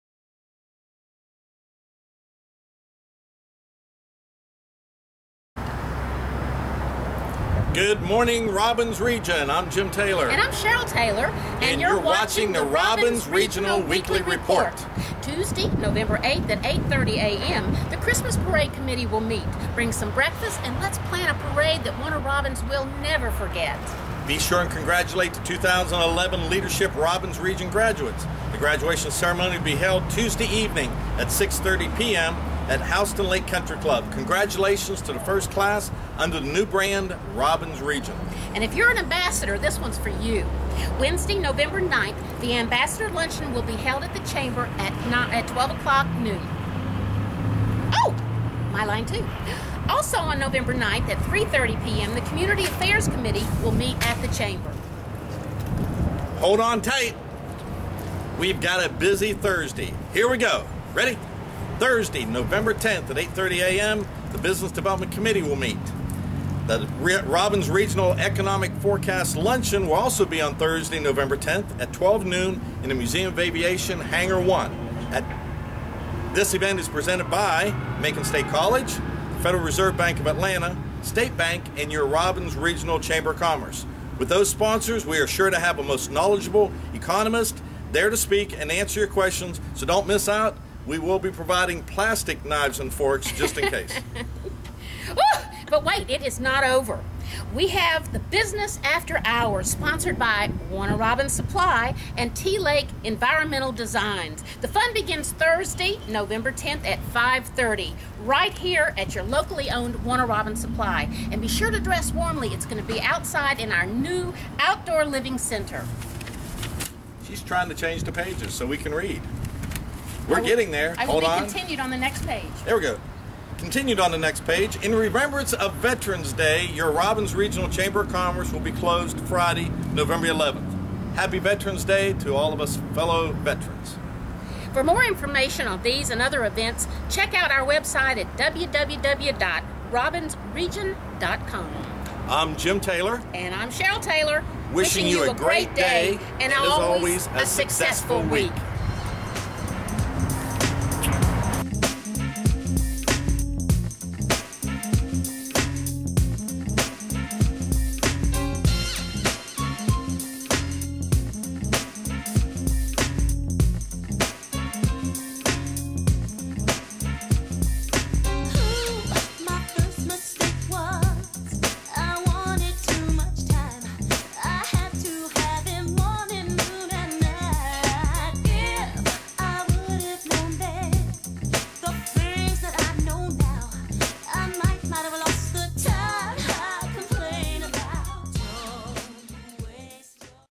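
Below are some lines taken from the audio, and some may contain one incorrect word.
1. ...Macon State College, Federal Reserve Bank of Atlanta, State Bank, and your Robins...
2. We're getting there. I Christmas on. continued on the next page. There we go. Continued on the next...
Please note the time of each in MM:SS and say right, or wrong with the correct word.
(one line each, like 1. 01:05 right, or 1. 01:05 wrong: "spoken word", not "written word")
1. 01:17 right
2. 02:00 wrong: "Hold", not "Christmas".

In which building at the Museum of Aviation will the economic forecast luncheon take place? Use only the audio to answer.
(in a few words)
Hangar 1.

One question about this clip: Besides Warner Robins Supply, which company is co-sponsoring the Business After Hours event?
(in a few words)
T Lake Environmental Designs.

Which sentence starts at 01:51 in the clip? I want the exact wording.
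And be sure to dress warmly.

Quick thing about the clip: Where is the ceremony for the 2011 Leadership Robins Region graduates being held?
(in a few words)
Houston Lake Country Club.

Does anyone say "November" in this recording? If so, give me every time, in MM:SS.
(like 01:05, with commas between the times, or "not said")
00:15, 00:41, 00:50, 01:02, 01:10, 01:46, 02:09.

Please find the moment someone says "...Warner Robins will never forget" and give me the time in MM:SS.
00:22.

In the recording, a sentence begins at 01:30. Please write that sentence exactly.
We will be providing plastic knives and forks just in case.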